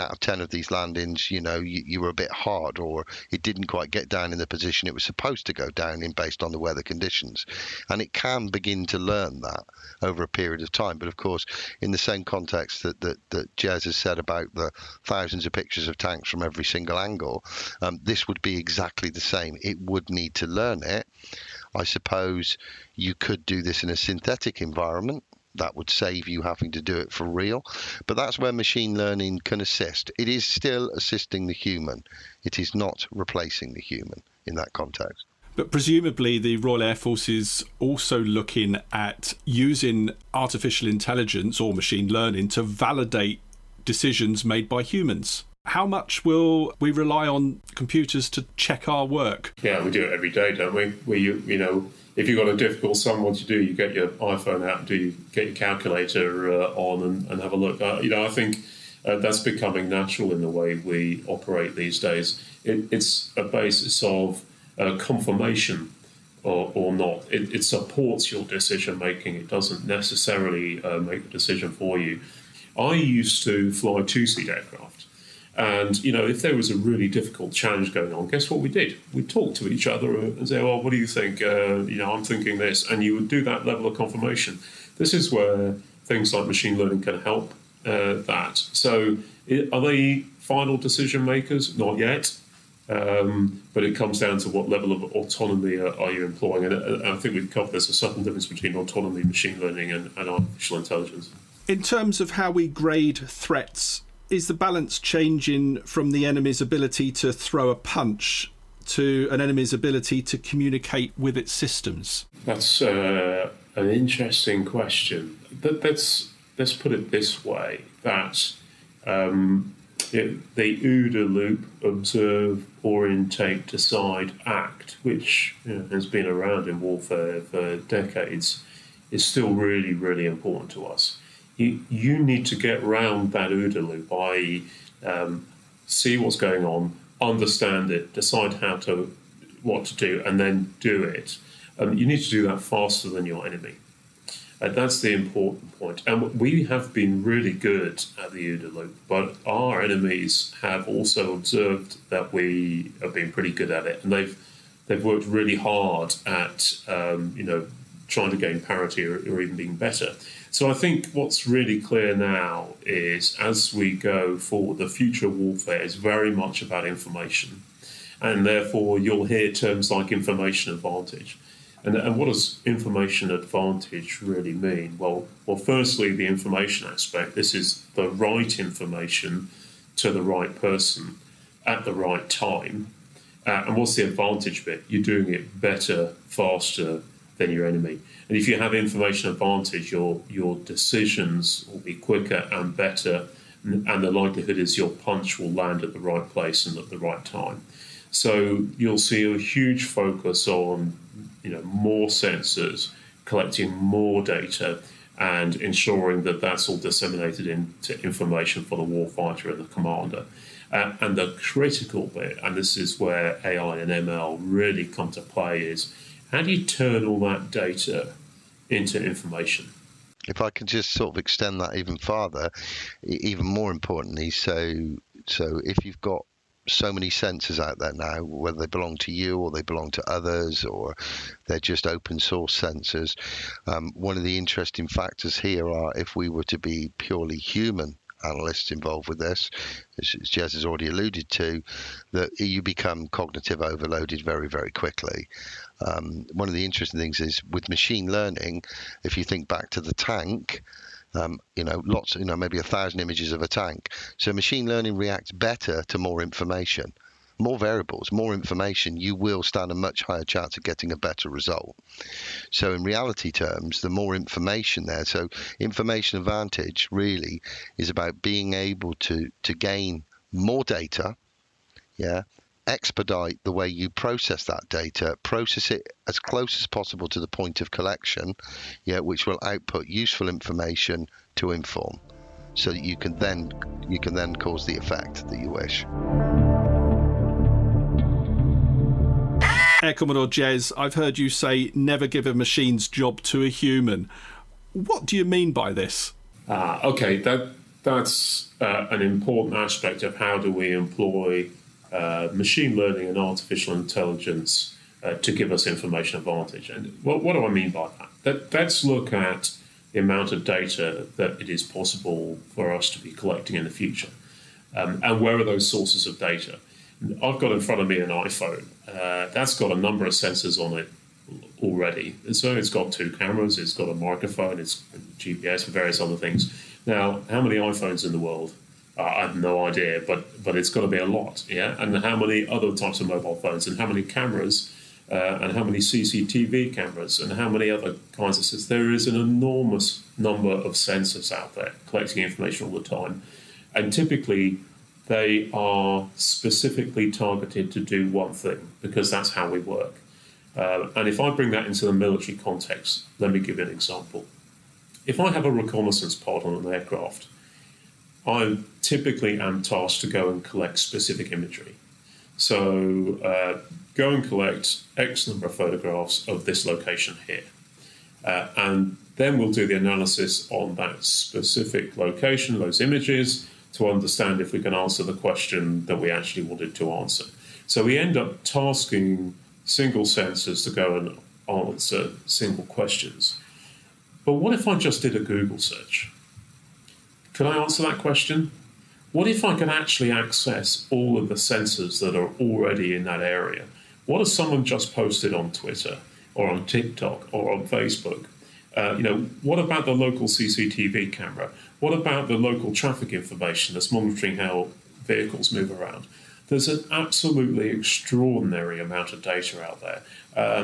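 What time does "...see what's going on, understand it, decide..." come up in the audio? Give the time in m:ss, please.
2:15.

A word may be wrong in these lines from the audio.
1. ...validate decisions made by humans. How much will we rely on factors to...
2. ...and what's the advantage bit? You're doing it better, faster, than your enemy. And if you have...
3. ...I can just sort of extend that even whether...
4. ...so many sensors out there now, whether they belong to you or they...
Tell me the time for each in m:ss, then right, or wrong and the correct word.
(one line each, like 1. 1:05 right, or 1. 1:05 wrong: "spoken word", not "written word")
1. 0:42 wrong: "computers", not "factors"
2. 3:03 right
3. 3:40 wrong: "farther", not "whether"
4. 3:46 right.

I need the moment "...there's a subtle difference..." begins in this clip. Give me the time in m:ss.
1:37.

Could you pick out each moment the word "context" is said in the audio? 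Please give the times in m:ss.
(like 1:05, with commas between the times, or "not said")
0:12, 0:34, 5:52.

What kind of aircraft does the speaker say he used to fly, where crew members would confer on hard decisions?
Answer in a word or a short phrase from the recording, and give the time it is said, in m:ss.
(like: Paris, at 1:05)
Two seat aircraft, at 1:14.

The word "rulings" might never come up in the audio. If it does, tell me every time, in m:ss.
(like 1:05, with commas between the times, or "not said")
not said.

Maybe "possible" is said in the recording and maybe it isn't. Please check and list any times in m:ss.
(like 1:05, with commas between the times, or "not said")
4:36, 5:11.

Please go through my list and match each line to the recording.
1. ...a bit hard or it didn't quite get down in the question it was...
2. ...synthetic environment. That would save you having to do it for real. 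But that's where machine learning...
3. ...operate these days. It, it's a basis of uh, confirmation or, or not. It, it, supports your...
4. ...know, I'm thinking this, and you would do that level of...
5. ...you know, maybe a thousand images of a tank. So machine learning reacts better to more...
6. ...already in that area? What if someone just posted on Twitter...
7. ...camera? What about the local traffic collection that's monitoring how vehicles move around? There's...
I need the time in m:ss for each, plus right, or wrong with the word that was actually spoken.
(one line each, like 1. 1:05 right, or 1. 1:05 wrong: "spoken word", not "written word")
1. 0:02 wrong: "position", not "question"
2. 0:23 right
3. 1:01 right
4. 1:21 right
5. 4:12 right
6. 6:32 right
7. 6:41 wrong: "information", not "collection".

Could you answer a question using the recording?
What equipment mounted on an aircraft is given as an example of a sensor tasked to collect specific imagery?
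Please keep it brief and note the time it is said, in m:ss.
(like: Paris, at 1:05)
Reconnaissance pod, at 5:55.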